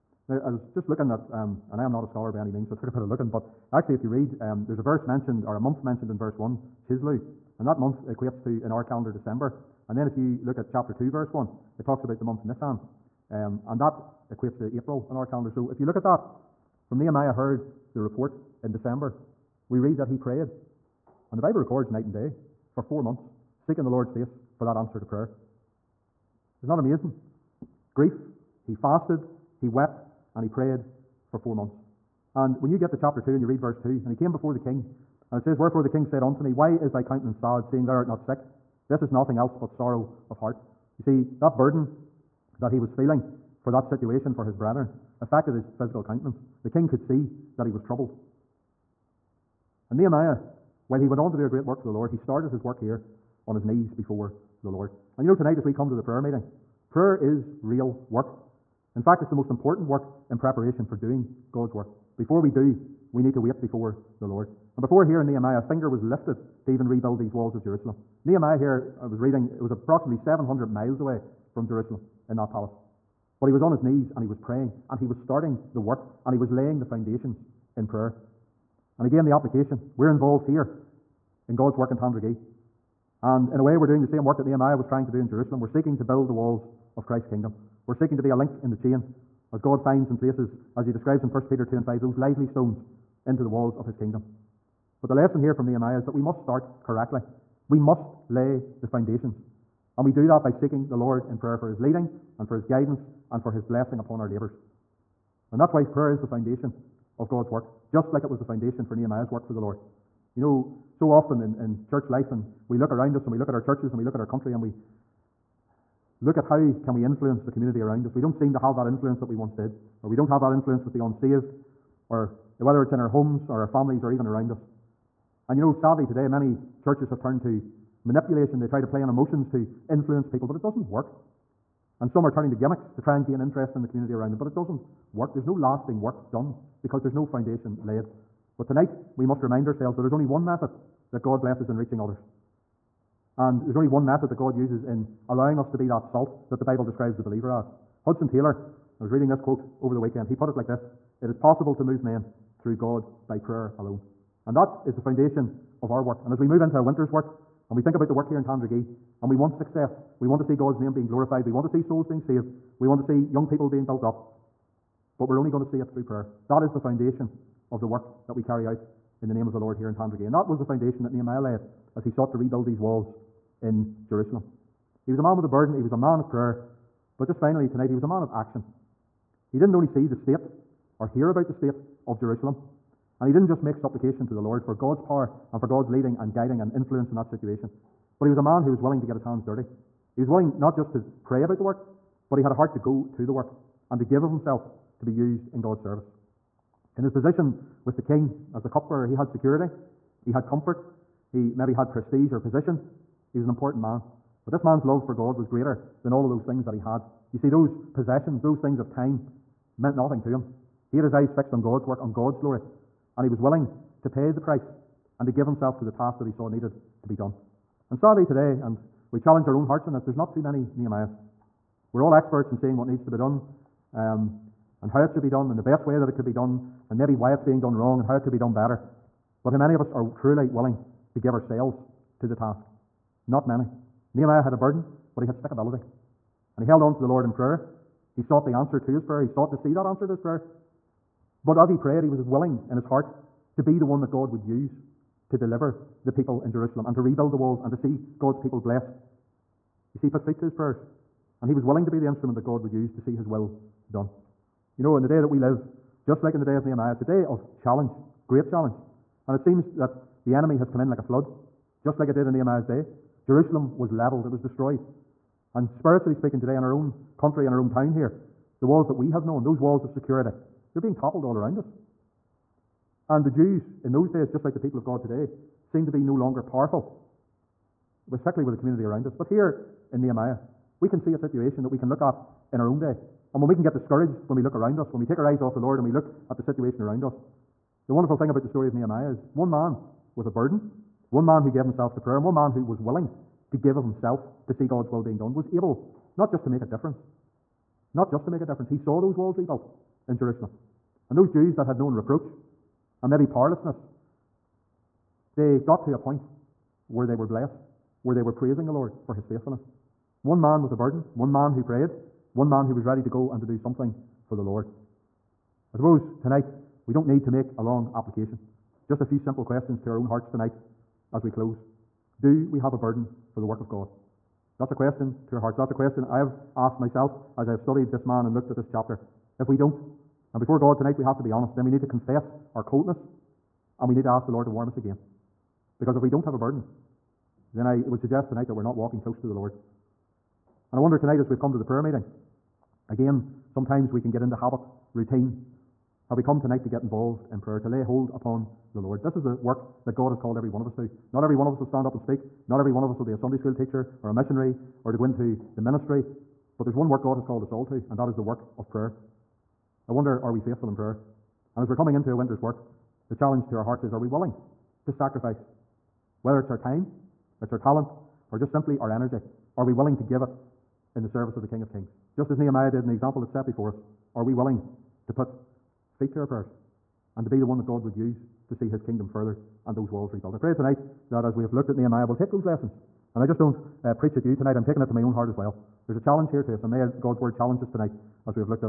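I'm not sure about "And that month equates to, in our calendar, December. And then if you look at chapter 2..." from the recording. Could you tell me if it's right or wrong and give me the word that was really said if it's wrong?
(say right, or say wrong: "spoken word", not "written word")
right.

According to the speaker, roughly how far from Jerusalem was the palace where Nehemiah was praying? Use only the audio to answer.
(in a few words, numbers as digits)
700 miles.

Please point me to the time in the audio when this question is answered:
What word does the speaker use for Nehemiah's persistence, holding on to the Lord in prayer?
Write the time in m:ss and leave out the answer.
3:55.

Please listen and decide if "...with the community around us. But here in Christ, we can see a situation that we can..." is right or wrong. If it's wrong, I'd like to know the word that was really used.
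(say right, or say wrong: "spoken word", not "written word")
wrong: "Nehemiah", not "Christ".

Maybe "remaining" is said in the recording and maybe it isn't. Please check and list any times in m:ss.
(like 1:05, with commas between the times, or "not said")
not said.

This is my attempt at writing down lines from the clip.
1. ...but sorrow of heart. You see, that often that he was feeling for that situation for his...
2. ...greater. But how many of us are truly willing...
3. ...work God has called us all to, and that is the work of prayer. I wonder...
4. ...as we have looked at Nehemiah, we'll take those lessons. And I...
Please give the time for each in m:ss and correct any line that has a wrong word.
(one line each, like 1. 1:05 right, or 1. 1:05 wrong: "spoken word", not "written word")
1. 0:39 wrong: "burden", not "often"
2. 3:48 wrong: "better", not "greater"
3. 5:56 right
4. 6:21 right.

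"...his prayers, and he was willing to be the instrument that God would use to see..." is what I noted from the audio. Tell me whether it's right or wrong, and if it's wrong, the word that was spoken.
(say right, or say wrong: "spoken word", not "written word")
right.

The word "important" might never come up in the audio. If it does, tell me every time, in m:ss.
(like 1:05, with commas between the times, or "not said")
0:59, 3:23.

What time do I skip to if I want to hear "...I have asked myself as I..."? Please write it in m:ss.
5:26.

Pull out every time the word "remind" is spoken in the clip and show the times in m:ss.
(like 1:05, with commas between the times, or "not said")
2:19.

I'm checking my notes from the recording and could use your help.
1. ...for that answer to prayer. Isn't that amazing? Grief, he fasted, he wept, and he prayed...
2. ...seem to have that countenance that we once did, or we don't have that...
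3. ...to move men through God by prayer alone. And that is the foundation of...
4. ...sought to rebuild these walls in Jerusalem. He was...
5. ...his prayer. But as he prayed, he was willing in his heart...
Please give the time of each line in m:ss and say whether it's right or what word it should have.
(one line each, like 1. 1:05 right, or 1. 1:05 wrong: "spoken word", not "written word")
1. 0:24 right
2. 1:58 wrong: "influence", not "countenance"
3. 2:31 right
4. 2:52 right
5. 4:00 right.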